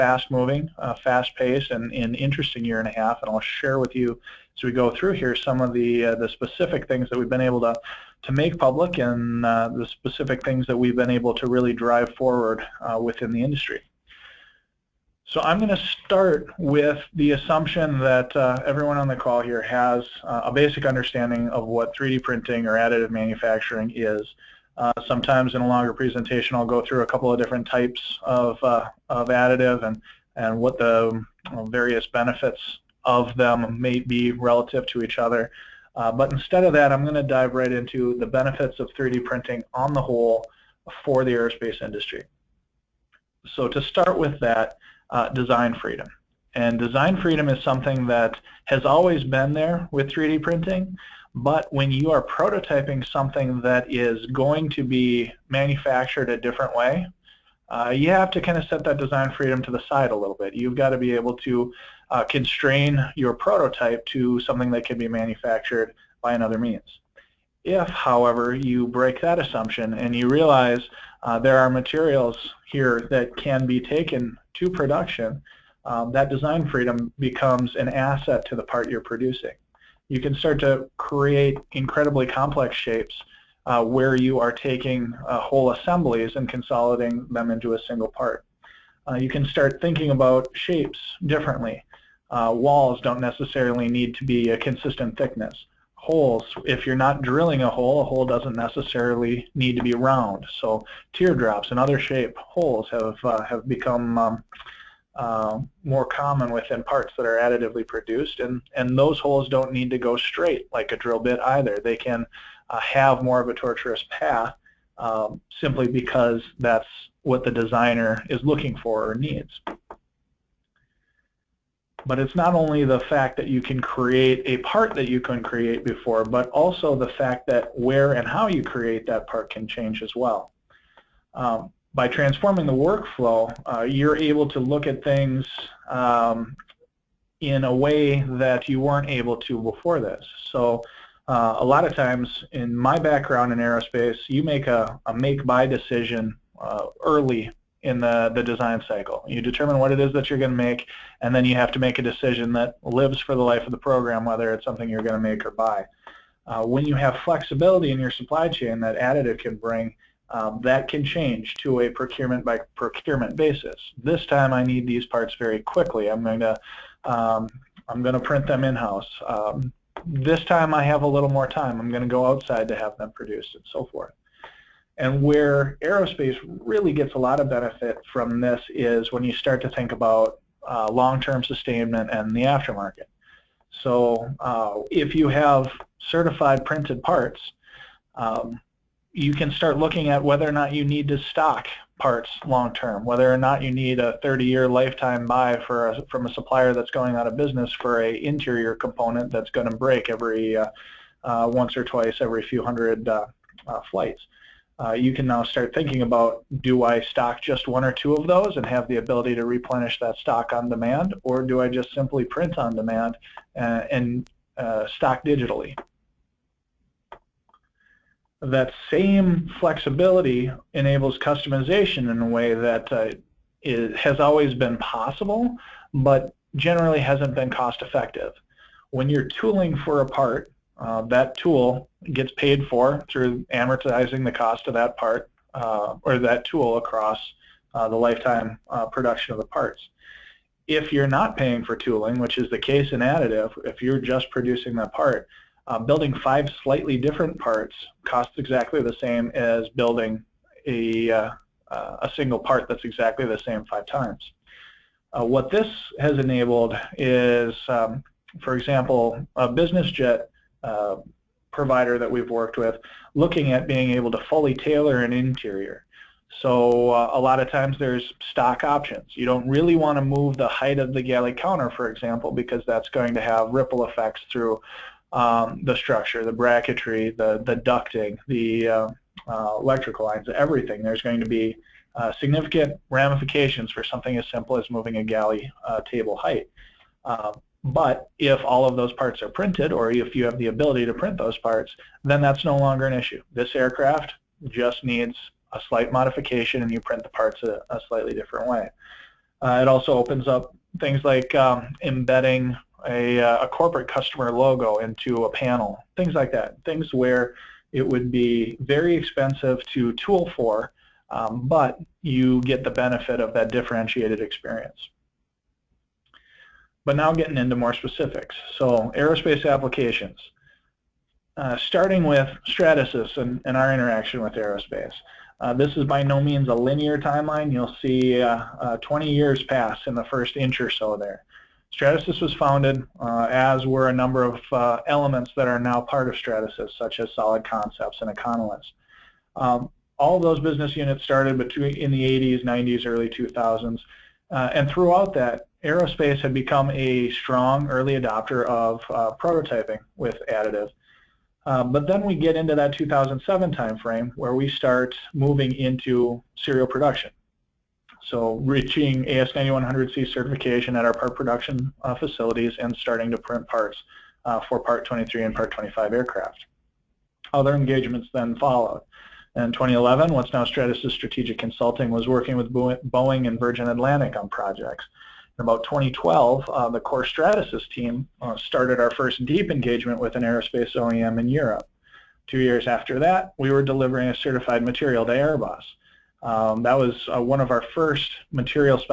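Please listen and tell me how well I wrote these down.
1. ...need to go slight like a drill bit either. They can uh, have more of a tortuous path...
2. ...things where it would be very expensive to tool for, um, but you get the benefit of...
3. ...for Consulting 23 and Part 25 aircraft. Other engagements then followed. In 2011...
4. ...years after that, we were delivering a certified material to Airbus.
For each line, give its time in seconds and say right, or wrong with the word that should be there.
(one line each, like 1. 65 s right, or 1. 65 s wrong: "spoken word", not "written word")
1. 109 s wrong: "straight", not "slight"
2. 306 s right
3. 364 s wrong: "Part", not "Consulting"
4. 382 s right.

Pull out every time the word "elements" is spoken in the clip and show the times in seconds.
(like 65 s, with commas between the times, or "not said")
334 s.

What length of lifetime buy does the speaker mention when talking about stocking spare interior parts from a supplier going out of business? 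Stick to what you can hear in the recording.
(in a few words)
30-year.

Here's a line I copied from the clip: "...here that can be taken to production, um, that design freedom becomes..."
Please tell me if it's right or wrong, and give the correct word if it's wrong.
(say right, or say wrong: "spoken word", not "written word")
right.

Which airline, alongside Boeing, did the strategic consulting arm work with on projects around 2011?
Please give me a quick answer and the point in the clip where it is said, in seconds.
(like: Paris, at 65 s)
Virgin Atlantic, at 373 s.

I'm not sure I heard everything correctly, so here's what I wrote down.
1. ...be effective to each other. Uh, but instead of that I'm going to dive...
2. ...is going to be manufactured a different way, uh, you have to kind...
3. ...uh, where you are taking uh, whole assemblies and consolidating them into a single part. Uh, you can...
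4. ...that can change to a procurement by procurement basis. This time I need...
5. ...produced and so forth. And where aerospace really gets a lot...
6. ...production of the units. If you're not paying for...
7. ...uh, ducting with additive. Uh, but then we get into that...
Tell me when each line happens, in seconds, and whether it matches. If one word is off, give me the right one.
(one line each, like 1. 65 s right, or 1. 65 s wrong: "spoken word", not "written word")
1. 33 s wrong: "relative", not "effective"
2. 53 s right
3. 83 s right
4. 160 s right
5. 173 s right
6. 238 s wrong: "parts", not "units"
7. 348 s wrong: "prototyping", not "ducting".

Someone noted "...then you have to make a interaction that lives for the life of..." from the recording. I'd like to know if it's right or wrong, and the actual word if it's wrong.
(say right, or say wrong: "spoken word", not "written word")
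wrong: "decision", not "interaction".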